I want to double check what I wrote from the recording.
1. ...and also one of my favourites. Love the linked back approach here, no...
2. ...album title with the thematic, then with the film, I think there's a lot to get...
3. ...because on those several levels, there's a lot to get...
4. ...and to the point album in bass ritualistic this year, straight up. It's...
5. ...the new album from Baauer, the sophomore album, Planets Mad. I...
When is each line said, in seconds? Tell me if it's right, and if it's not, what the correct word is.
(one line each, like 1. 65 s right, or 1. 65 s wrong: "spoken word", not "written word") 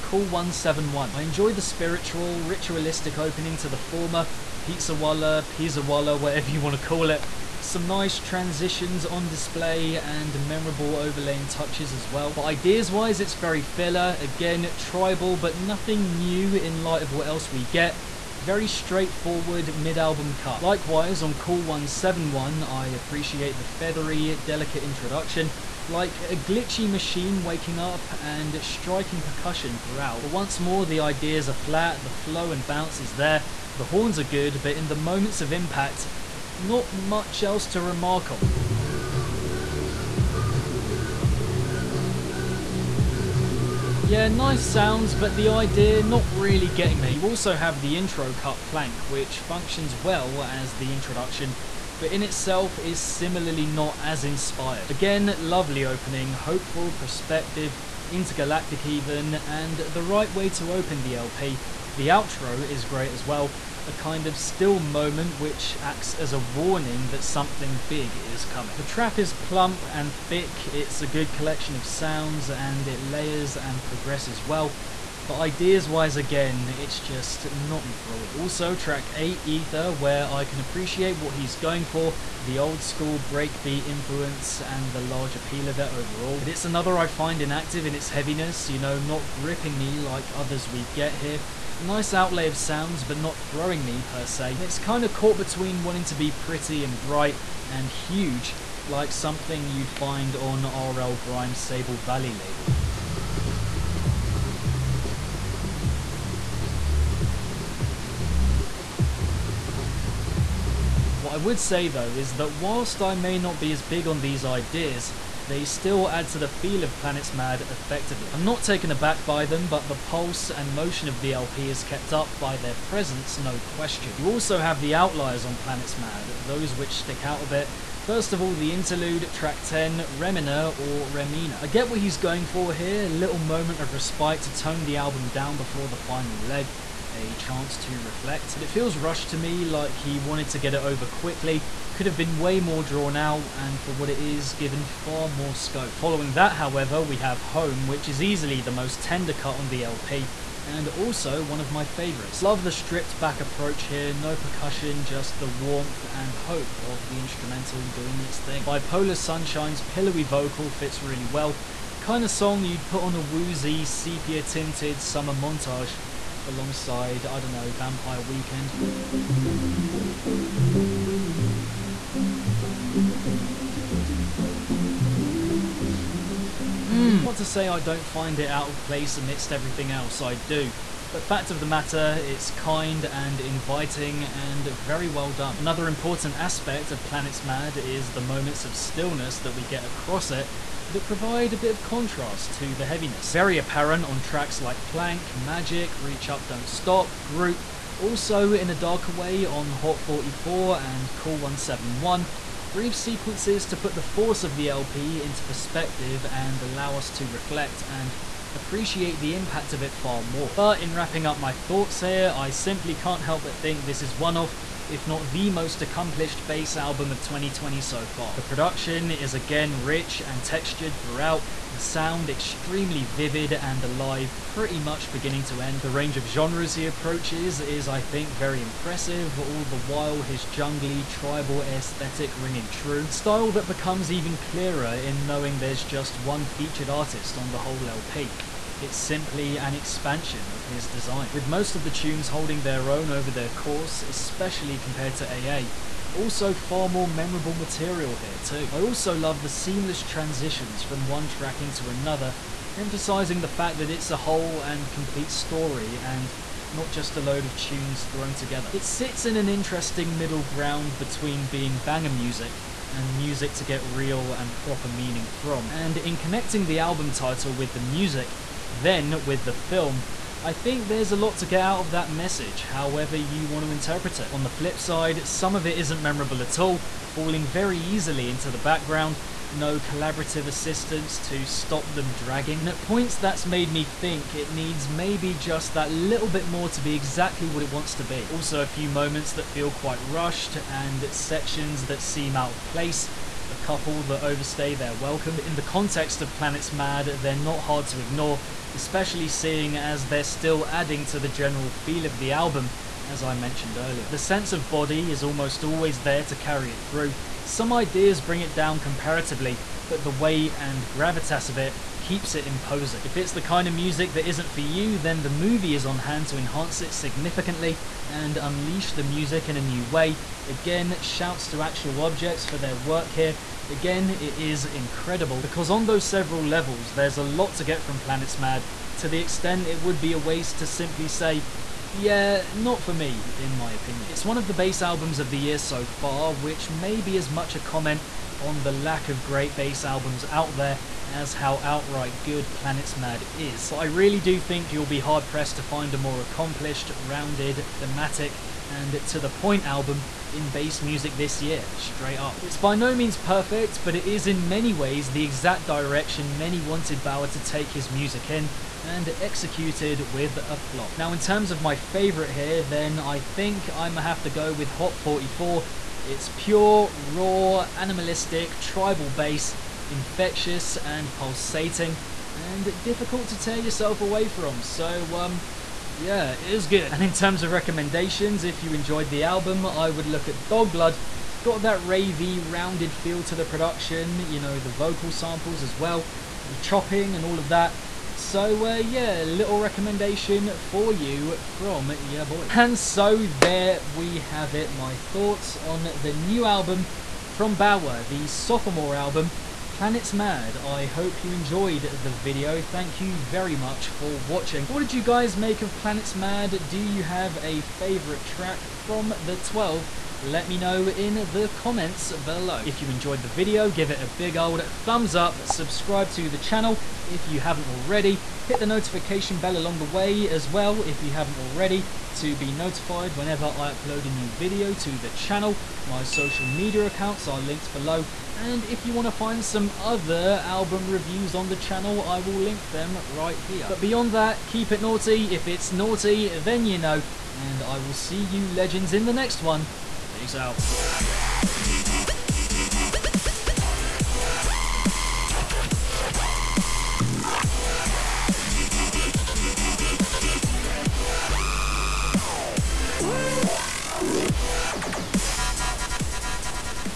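1. 150 s wrong: "stripped", not "linked"
2. 266 s wrong: "music", not "thematic"
3. 325 s right
4. 348 s wrong: "music", not "ritualistic"
5. 396 s right.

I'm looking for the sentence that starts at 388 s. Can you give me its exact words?
So uh, yeah, little recommendation for you from your boy.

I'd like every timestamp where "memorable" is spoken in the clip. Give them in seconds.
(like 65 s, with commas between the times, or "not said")
10 s, 247 s, 276 s.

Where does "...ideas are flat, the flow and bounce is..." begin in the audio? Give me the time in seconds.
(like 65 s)
30 s.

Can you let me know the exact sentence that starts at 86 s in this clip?
But it's another I find inactive in its heaviness, you know, not gripping me like others we get here.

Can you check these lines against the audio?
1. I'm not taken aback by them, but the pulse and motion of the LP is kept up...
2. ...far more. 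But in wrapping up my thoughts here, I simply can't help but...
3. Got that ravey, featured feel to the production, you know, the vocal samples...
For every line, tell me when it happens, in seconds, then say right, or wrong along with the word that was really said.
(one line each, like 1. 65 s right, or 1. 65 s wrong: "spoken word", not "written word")
1. 118 s right
2. 209 s right
3. 381 s wrong: "rounded", not "featured".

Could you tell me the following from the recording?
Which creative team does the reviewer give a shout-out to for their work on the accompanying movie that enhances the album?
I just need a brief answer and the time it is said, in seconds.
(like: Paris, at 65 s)
Actual Objects, at 321 s.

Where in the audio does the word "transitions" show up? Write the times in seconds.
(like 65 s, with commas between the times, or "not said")
8 s, 250 s.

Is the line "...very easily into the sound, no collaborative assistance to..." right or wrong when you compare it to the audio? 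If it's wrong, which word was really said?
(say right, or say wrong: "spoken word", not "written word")
wrong: "background", not "sound".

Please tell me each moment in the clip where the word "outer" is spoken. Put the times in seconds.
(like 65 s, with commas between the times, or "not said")
not said.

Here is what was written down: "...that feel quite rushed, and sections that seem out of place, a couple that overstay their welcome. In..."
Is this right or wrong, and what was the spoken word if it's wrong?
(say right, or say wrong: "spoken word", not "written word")
right.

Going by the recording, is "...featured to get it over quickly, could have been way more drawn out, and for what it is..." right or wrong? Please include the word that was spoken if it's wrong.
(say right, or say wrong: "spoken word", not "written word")
wrong: "wanted", not "featured".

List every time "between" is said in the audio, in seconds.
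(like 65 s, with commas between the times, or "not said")
95 s, 260 s.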